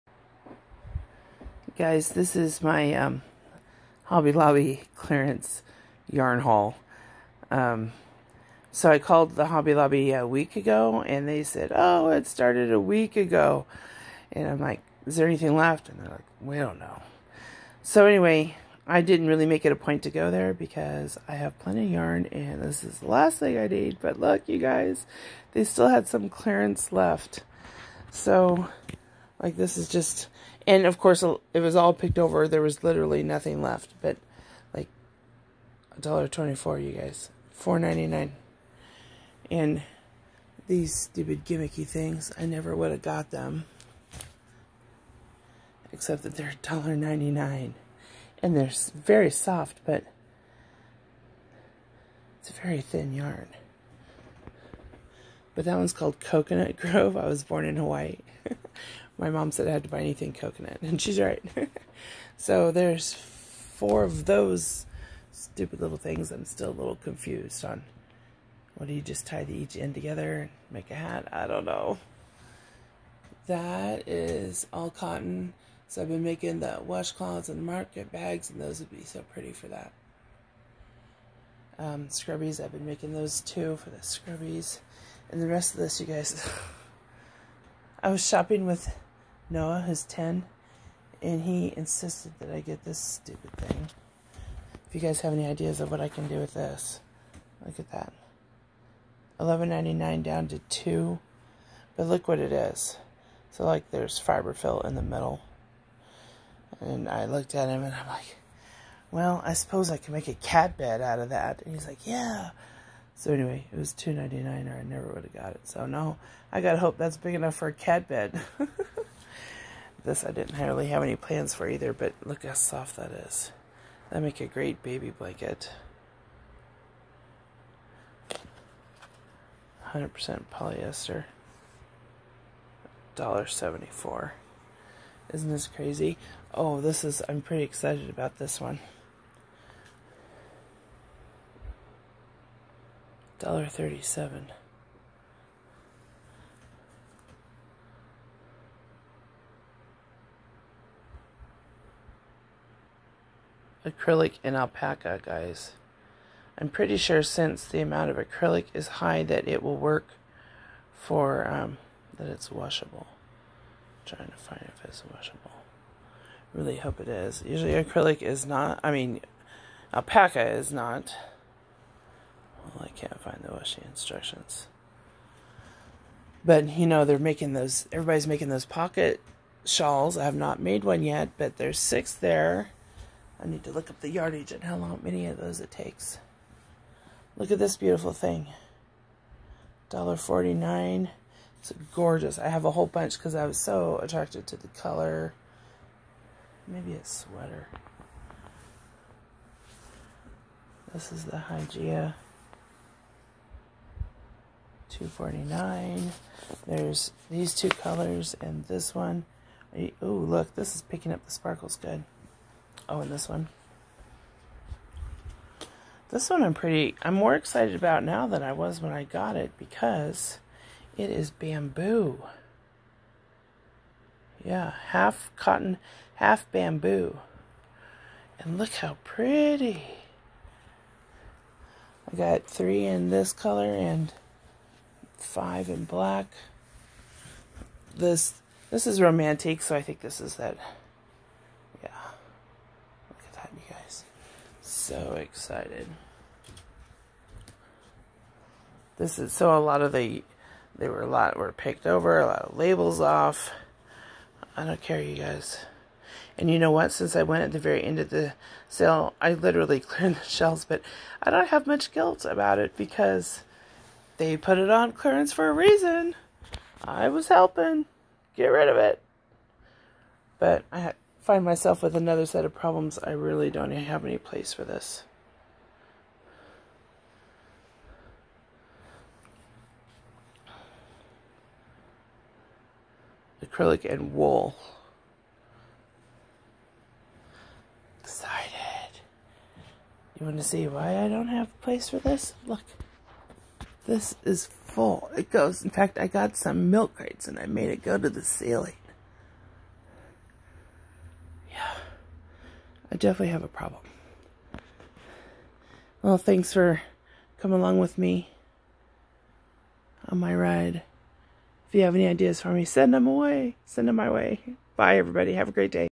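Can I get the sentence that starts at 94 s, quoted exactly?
If you guys have any ideas of what I can do with this, look at that.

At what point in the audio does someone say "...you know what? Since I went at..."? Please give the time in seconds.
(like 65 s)
256 s.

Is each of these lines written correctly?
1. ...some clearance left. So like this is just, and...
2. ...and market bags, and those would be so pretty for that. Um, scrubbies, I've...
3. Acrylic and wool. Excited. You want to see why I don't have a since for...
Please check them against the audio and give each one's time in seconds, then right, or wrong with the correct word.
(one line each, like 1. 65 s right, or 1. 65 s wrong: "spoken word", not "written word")
1. 26 s right
2. 77 s right
3. 283 s wrong: "place", not "since".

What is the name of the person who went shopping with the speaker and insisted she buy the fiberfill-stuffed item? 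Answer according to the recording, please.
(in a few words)
Noah.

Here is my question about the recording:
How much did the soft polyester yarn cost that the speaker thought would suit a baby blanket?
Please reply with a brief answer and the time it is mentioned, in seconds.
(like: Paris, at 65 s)
$1.74, at 133 s.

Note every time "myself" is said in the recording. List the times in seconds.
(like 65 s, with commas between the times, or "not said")
271 s.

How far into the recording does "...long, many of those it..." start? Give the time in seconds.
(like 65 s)
184 s.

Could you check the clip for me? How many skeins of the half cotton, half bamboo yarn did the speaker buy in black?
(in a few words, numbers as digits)
5.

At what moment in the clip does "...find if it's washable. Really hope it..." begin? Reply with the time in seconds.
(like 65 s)
164 s.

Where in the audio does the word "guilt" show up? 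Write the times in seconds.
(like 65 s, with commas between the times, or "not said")
261 s.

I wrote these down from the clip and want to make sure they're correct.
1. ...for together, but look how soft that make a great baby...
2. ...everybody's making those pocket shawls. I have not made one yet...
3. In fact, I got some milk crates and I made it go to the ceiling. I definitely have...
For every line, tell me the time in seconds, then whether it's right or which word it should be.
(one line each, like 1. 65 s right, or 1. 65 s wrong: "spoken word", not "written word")
1. 121 s wrong: "either", not "together"
2. 177 s right
3. 295 s right.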